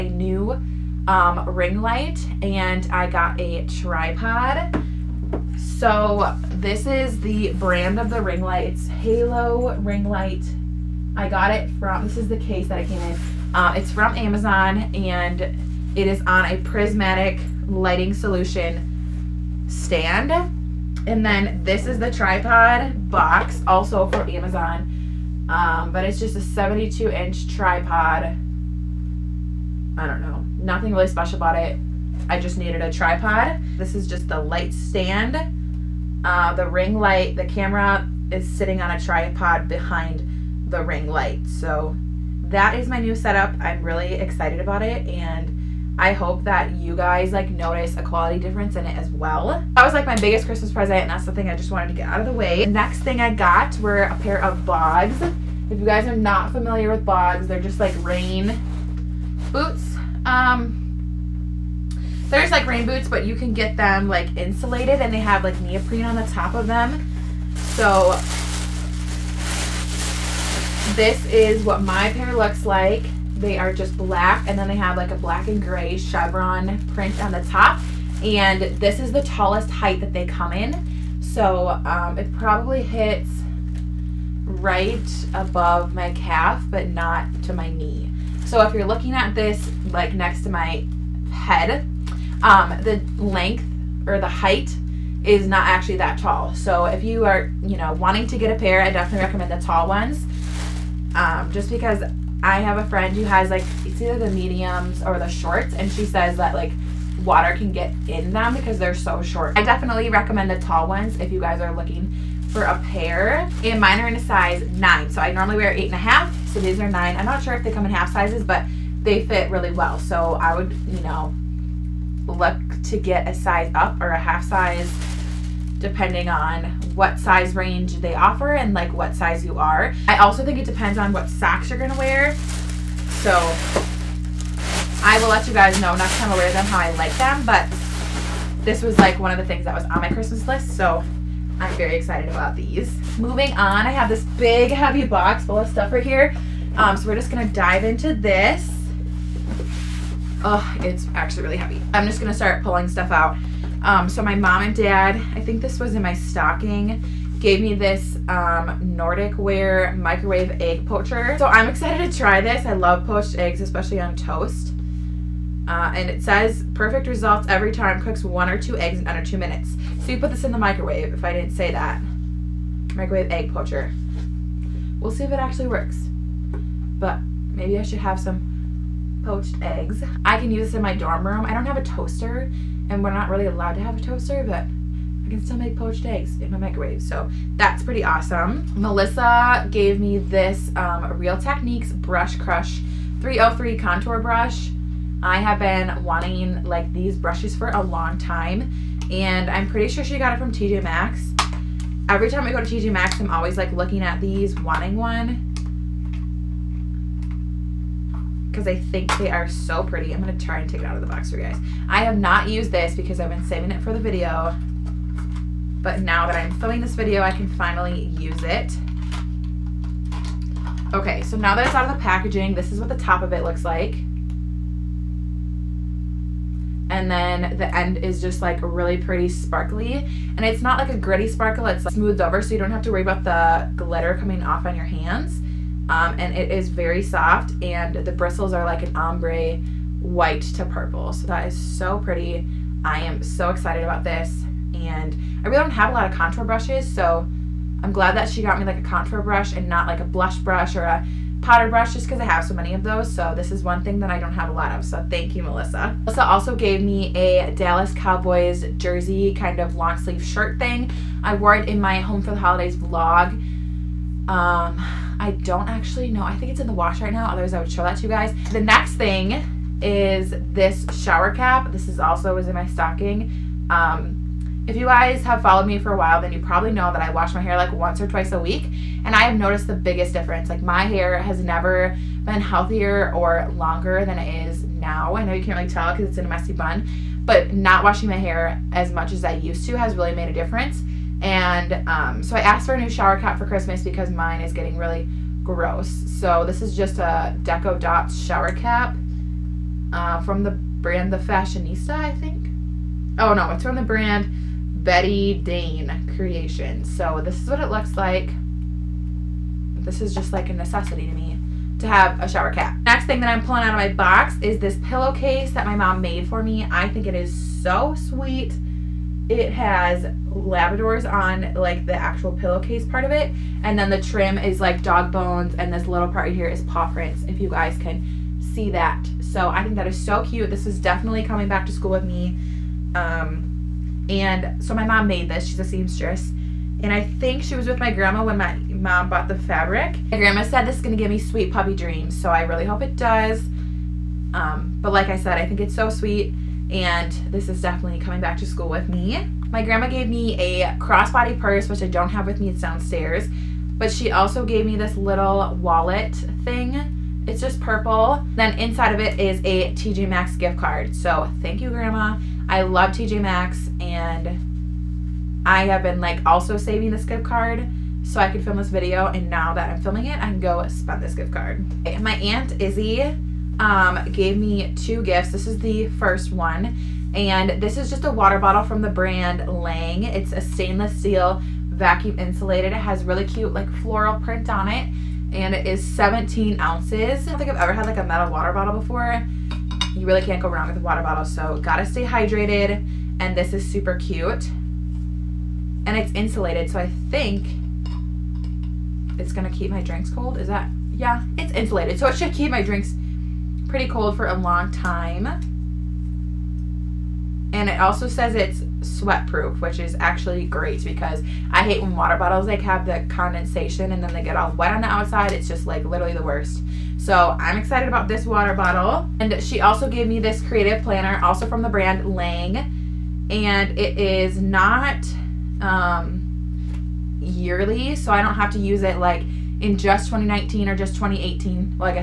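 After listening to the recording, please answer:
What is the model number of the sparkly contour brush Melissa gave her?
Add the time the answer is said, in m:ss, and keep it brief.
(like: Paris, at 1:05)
303, at 3:13.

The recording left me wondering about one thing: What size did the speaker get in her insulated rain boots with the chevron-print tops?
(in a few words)
9.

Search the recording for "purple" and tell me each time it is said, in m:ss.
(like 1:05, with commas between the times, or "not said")
4:00, 5:57.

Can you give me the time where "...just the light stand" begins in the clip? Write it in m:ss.
0:34.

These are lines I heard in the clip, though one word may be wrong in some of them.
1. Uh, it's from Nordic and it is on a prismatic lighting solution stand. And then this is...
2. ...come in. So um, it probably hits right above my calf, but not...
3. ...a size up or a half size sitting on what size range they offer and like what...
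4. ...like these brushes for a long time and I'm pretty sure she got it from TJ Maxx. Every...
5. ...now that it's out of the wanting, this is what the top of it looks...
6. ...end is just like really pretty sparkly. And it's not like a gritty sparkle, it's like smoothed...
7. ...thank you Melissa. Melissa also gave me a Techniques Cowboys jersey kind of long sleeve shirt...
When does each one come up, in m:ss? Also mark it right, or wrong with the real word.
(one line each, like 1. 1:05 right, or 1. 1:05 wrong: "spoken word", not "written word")
1. 0:13 wrong: "Amazon", not "Nordic"
2. 1:20 right
3. 2:03 wrong: "depending", not "sitting"
4. 3:16 right
5. 3:41 wrong: "packaging", not "wanting"
6. 3:47 right
7. 4:15 wrong: "Dallas", not "Techniques".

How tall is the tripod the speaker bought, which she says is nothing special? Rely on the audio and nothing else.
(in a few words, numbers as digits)
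72 inch.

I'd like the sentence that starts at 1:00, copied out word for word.
Um, there's like rain boots, but you can get them like insulated and they have like neoprene on the top of them.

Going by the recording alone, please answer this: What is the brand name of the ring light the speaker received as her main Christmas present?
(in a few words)
Halo Ring Light.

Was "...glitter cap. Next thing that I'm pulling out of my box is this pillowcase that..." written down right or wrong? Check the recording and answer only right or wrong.
wrong.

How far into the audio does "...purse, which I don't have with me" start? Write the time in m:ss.
5:51.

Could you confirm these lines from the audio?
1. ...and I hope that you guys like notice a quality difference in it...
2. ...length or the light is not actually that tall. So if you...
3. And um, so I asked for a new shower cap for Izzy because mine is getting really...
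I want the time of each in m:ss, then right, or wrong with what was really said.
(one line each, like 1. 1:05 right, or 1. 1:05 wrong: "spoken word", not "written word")
1. 0:45 right
2. 1:33 wrong: "height", not "light"
3. 4:51 wrong: "Christmas", not "Izzy".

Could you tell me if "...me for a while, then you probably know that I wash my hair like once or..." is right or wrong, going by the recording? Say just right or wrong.
right.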